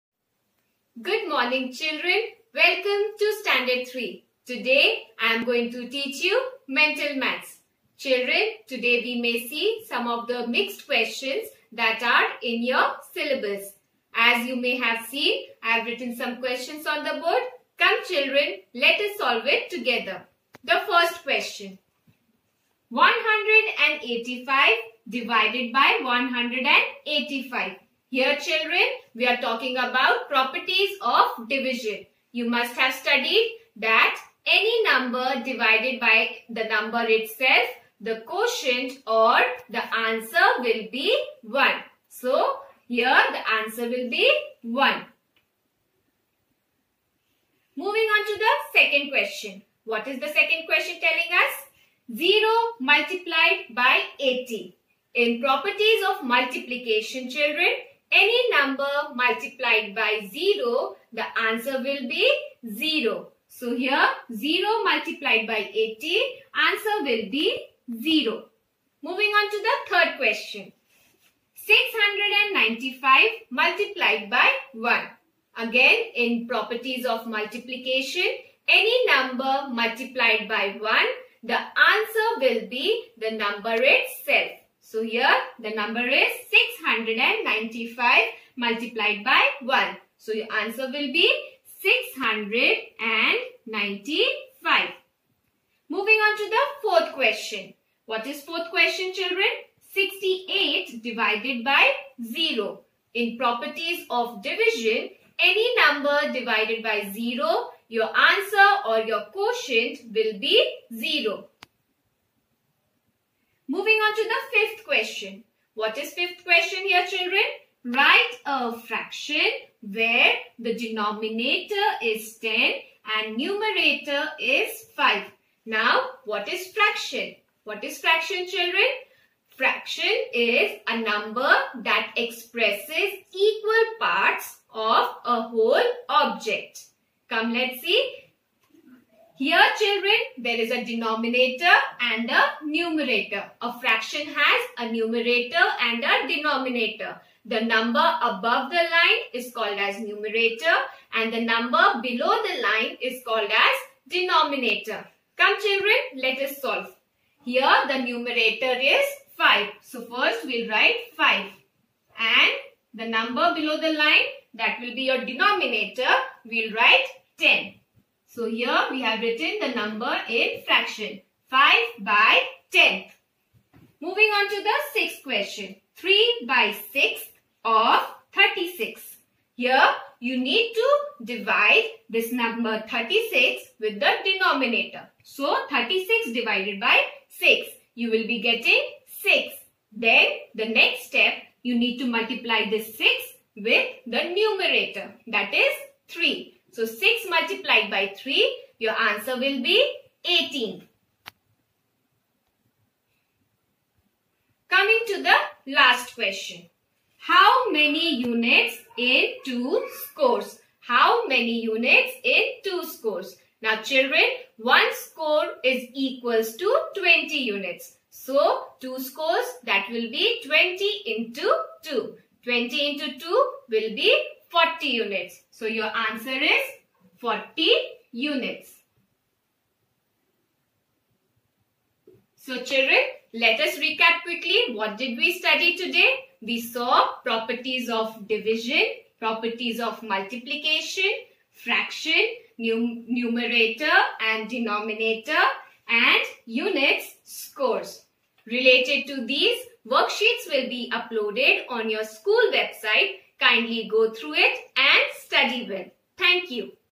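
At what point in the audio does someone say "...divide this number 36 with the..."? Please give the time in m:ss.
3:01.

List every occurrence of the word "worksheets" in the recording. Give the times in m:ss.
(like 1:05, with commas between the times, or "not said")
4:09.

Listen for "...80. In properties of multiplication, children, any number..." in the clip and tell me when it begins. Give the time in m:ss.
0:54.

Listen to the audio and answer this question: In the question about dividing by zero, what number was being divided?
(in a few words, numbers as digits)
68.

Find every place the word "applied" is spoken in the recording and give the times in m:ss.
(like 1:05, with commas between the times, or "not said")
not said.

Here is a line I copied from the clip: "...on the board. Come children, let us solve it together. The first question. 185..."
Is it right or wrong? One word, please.
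right.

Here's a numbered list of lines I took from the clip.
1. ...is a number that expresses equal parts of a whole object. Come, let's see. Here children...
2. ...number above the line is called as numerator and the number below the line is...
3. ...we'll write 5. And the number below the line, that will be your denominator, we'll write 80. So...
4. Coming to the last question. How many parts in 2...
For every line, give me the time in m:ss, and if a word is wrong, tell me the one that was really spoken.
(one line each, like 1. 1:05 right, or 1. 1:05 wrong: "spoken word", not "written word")
1. 2:10 right
2. 2:27 right
3. 2:40 wrong: "10", not "80"
4. 3:24 wrong: "units", not "parts".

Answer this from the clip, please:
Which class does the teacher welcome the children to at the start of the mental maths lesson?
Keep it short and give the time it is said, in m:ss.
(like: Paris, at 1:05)
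Standard 3, at 0:03.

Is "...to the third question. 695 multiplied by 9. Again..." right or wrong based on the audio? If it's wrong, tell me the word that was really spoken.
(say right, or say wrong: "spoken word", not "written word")
wrong: "1", not "9".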